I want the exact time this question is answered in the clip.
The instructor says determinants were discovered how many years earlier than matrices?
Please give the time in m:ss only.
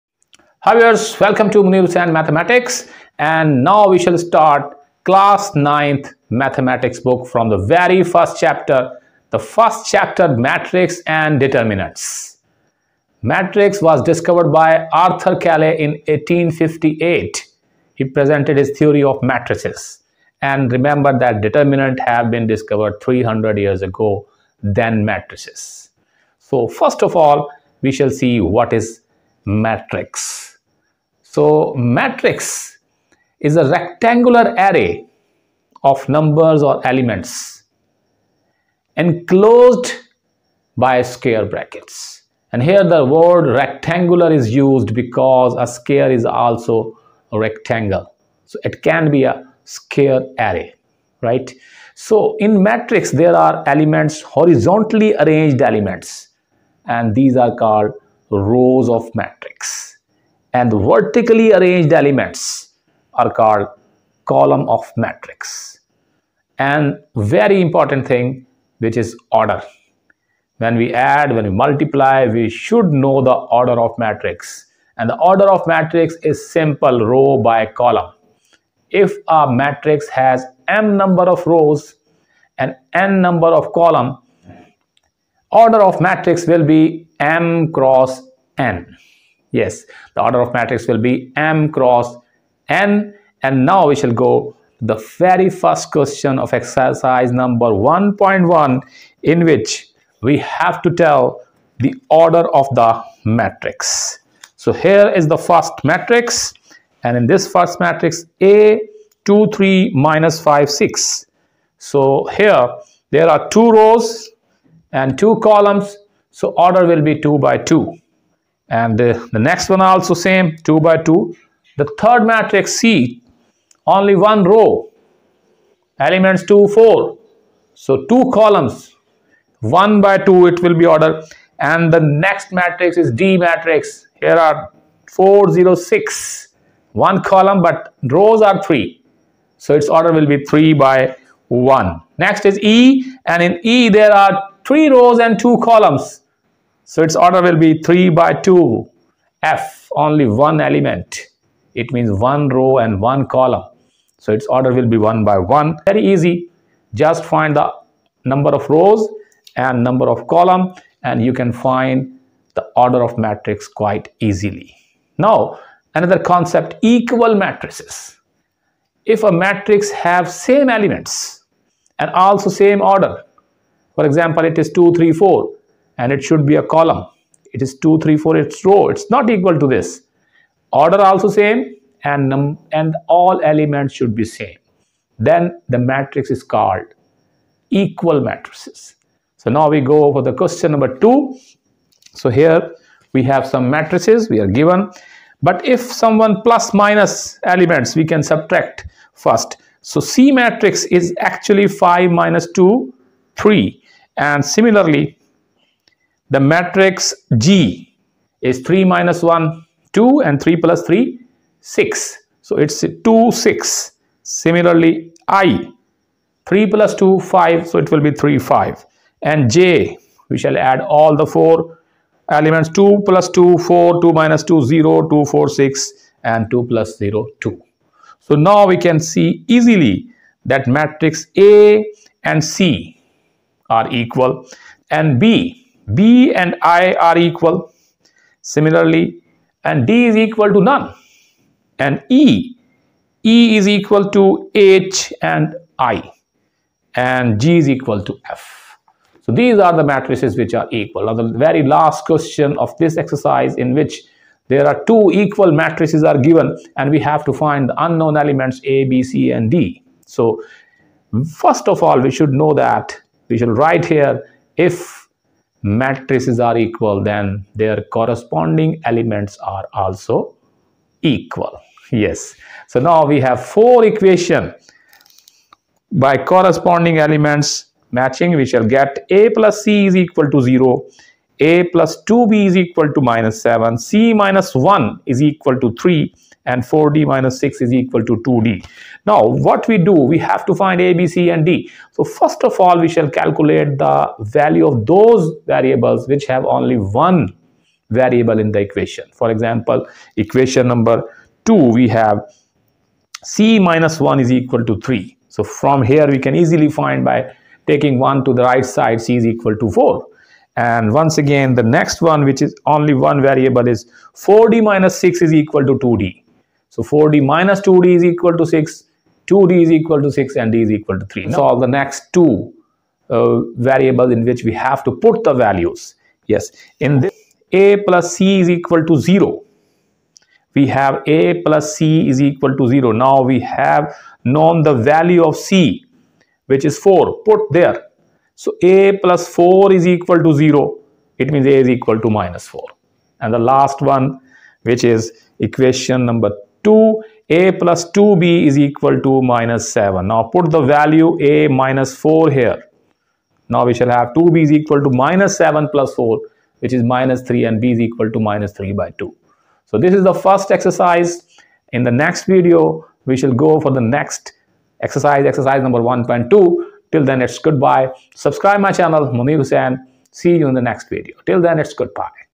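0:23.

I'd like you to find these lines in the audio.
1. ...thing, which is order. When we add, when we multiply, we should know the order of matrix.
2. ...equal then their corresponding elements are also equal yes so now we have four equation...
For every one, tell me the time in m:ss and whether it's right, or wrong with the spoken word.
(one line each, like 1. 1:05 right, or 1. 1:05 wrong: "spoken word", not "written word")
1. 1:08 right
2. 4:26 right.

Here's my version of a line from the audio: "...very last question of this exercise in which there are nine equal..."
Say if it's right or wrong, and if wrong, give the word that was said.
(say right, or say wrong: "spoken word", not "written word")
wrong: "two", not "nine".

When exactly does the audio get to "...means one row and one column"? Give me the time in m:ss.
2:31.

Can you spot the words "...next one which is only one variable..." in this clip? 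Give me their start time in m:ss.
5:11.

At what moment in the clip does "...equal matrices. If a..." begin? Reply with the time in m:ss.
2:46.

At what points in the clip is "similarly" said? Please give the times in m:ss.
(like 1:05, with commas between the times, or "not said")
3:24, 3:34, 3:58.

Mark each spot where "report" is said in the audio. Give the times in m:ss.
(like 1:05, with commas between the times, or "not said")
not said.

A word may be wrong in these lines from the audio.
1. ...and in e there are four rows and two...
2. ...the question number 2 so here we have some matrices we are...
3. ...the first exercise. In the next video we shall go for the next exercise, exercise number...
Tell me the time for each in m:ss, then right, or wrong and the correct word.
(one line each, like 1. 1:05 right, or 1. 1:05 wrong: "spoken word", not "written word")
1. 2:23 wrong: "three", not "four"
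2. 3:10 right
3. 6:00 right.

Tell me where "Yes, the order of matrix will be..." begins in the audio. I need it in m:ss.
1:29.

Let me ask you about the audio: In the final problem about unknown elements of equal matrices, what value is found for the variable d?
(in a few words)
3.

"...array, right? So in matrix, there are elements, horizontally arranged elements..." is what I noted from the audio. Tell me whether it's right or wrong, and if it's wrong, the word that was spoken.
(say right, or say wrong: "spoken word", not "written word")
right.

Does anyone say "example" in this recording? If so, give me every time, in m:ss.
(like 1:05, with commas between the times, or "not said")
2:54, 4:59.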